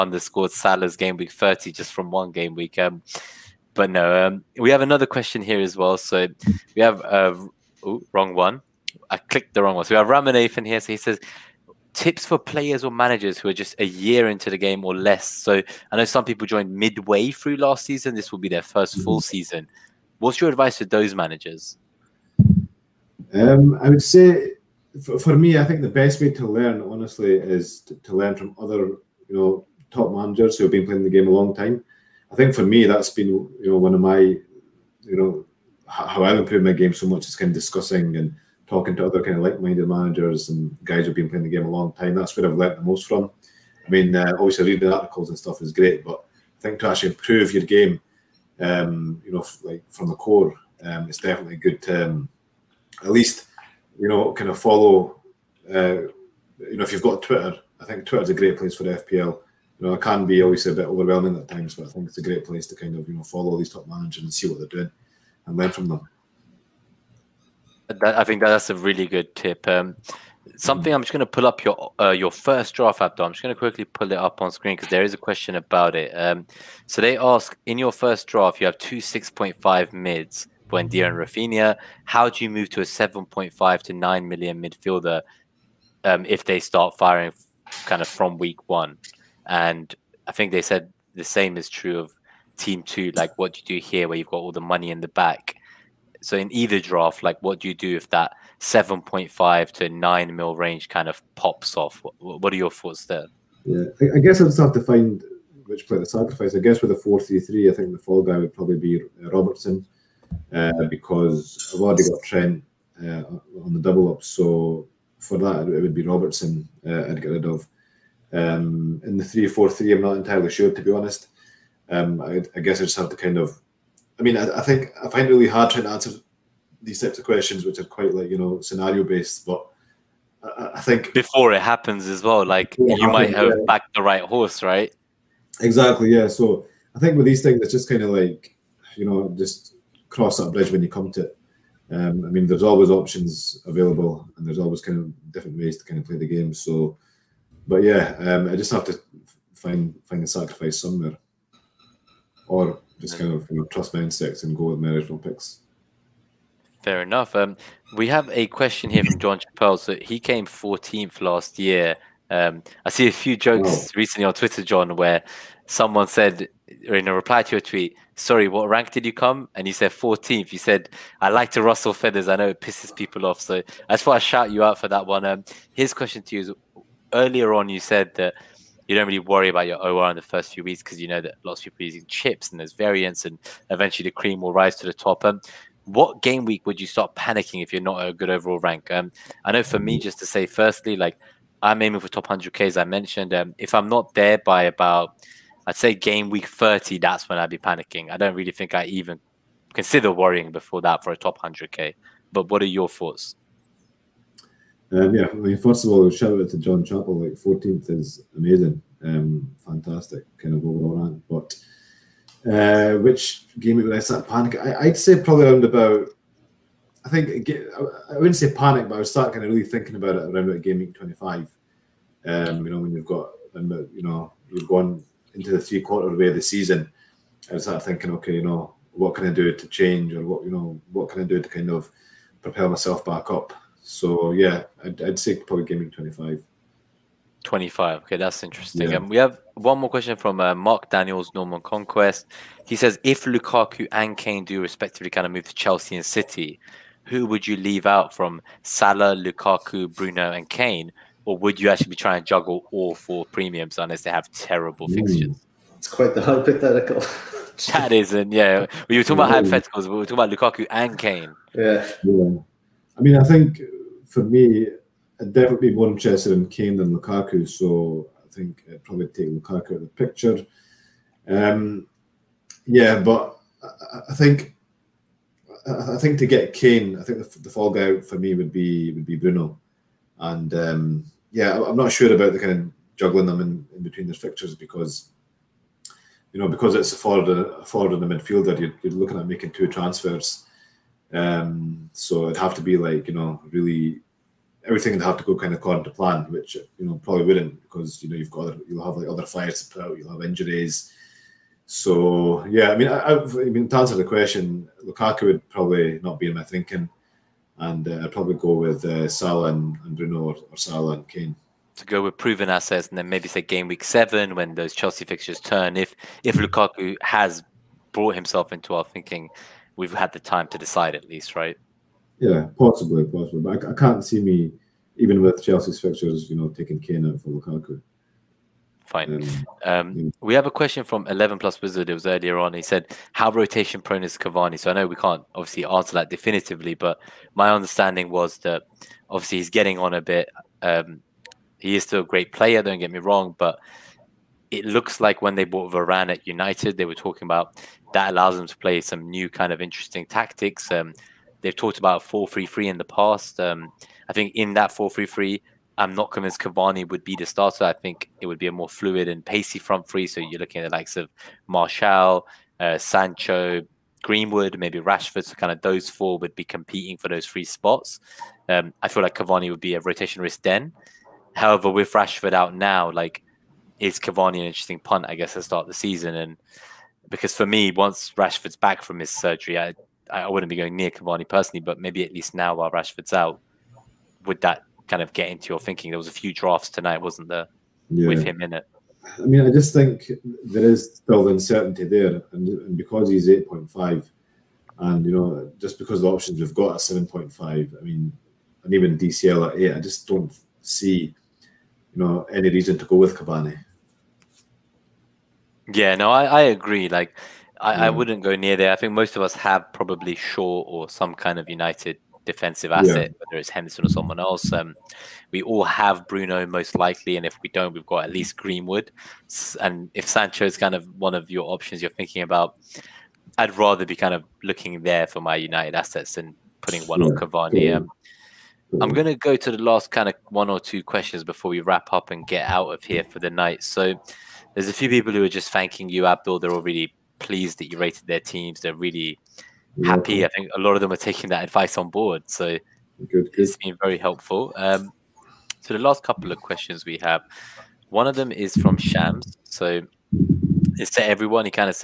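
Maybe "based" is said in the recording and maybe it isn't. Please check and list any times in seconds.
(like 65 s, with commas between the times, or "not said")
129 s.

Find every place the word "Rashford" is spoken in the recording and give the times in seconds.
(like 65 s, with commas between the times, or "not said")
364 s, 371 s, 378 s, 382 s.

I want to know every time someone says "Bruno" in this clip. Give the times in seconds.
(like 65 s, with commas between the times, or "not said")
249 s, 279 s, 309 s, 416 s.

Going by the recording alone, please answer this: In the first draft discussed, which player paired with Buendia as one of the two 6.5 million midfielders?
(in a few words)
Rafinha.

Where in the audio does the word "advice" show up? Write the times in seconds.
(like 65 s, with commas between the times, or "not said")
20 s, 441 s.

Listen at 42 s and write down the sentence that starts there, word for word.
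That's where I've learnt the most from.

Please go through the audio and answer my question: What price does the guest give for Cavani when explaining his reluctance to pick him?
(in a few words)
8.5.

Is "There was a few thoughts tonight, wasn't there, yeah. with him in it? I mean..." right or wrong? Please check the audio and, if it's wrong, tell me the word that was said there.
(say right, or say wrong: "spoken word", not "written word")
wrong: "drafts", not "thoughts".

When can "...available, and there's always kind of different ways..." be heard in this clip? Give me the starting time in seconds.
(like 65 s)
143 s.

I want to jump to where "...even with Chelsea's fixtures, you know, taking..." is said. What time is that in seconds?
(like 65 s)
324 s.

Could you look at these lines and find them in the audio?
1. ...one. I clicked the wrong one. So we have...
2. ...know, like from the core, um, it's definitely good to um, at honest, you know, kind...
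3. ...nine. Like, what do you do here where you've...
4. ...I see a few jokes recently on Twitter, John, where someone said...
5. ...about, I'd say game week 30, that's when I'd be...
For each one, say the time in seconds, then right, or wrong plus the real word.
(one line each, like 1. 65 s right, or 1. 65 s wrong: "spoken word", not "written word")
1. 8 s right
2. 49 s wrong: "least", not "honest"
3. 92 s wrong: "two", not "nine"
4. 162 s right
5. 194 s right.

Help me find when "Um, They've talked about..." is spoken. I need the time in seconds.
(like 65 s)
350 s.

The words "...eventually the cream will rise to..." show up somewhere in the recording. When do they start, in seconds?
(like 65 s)
183 s.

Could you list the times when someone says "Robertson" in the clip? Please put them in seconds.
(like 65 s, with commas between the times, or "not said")
109 s, 116 s.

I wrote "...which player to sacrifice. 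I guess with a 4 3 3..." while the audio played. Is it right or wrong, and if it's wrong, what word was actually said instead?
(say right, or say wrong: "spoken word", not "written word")
right.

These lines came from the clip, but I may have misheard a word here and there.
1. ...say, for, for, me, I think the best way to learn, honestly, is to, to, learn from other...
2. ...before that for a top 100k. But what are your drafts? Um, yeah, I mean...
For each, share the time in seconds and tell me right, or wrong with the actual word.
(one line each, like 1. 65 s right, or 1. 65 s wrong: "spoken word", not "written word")
1. 24 s right
2. 200 s wrong: "thoughts", not "drafts".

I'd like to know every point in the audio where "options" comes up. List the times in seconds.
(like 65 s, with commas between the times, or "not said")
142 s, 396 s, 421 s.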